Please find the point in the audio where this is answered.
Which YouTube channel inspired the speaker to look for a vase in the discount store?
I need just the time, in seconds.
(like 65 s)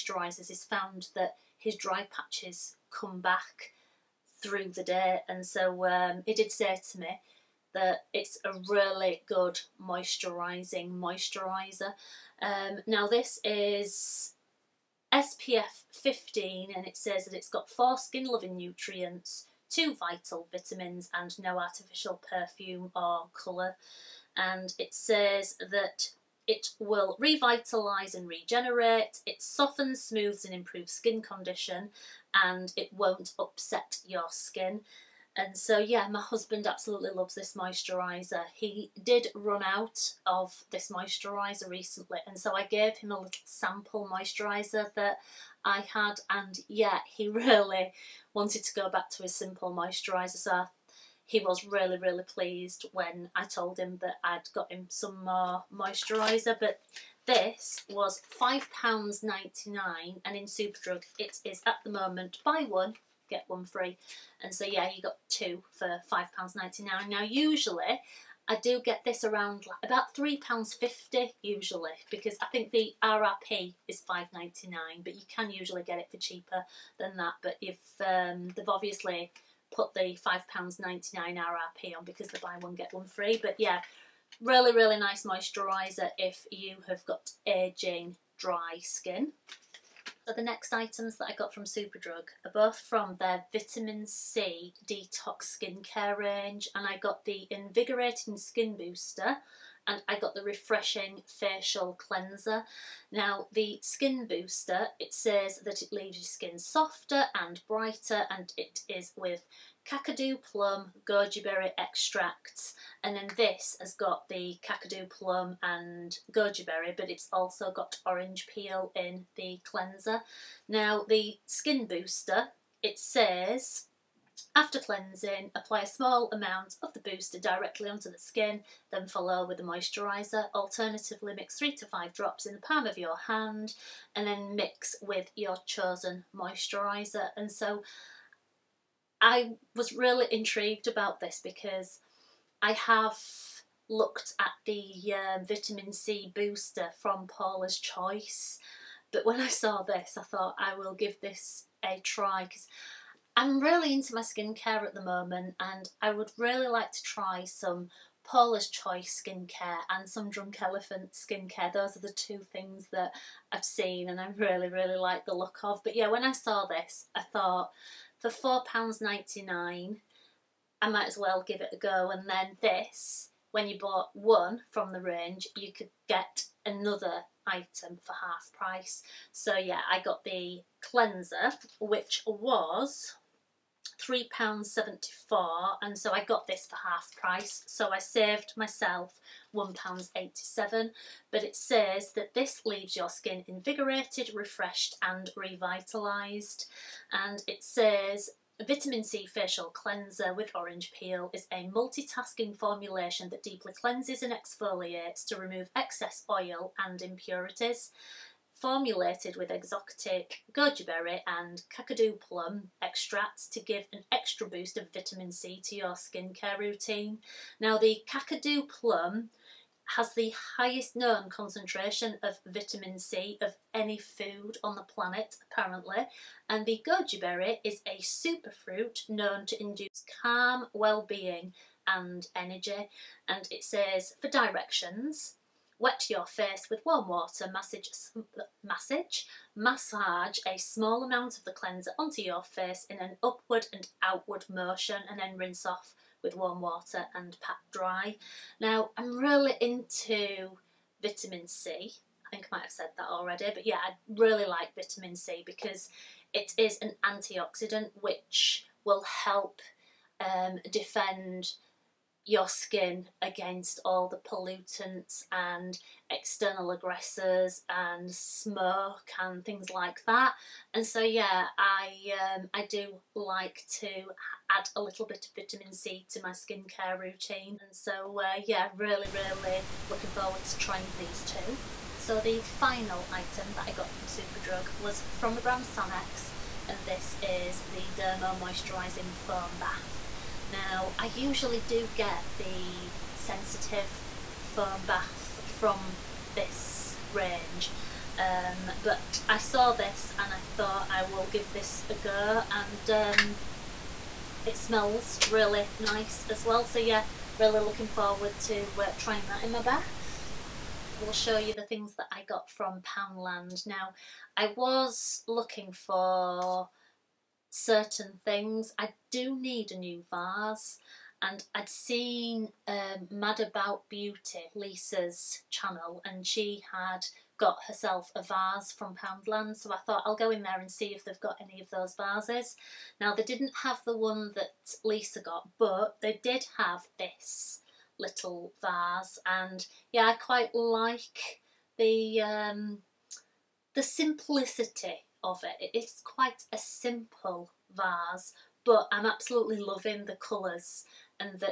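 323 s.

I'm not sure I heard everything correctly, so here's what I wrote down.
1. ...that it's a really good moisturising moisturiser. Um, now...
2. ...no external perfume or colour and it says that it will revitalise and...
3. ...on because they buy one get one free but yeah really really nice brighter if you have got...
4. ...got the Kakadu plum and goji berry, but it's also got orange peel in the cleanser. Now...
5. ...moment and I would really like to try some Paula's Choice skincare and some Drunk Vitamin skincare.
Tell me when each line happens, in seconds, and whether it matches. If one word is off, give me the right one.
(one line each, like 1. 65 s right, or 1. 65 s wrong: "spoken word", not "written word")
1. 7 s right
2. 21 s wrong: "artificial", not "external"
3. 81 s wrong: "moisturiser", not "brighter"
4. 113 s right
5. 155 s wrong: "Elephant", not "Vitamin".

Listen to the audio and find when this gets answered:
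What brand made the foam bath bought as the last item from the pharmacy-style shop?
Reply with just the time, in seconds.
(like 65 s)
285 s.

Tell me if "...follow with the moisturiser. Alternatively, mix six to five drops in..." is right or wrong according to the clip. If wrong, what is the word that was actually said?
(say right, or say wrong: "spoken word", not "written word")
wrong: "three", not "six".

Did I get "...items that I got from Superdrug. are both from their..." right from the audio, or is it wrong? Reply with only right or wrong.
right.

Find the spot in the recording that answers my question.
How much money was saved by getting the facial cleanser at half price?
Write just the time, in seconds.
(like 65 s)
189 s.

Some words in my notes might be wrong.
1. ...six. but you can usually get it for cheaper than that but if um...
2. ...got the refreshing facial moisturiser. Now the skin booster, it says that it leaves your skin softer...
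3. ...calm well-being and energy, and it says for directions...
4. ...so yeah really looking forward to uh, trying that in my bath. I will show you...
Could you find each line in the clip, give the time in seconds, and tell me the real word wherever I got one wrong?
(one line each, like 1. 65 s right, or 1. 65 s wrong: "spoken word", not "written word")
1. 74 s wrong: "nine", not "six"
2. 100 s wrong: "cleanser", not "moisturiser"
3. 230 s right
4. 306 s right.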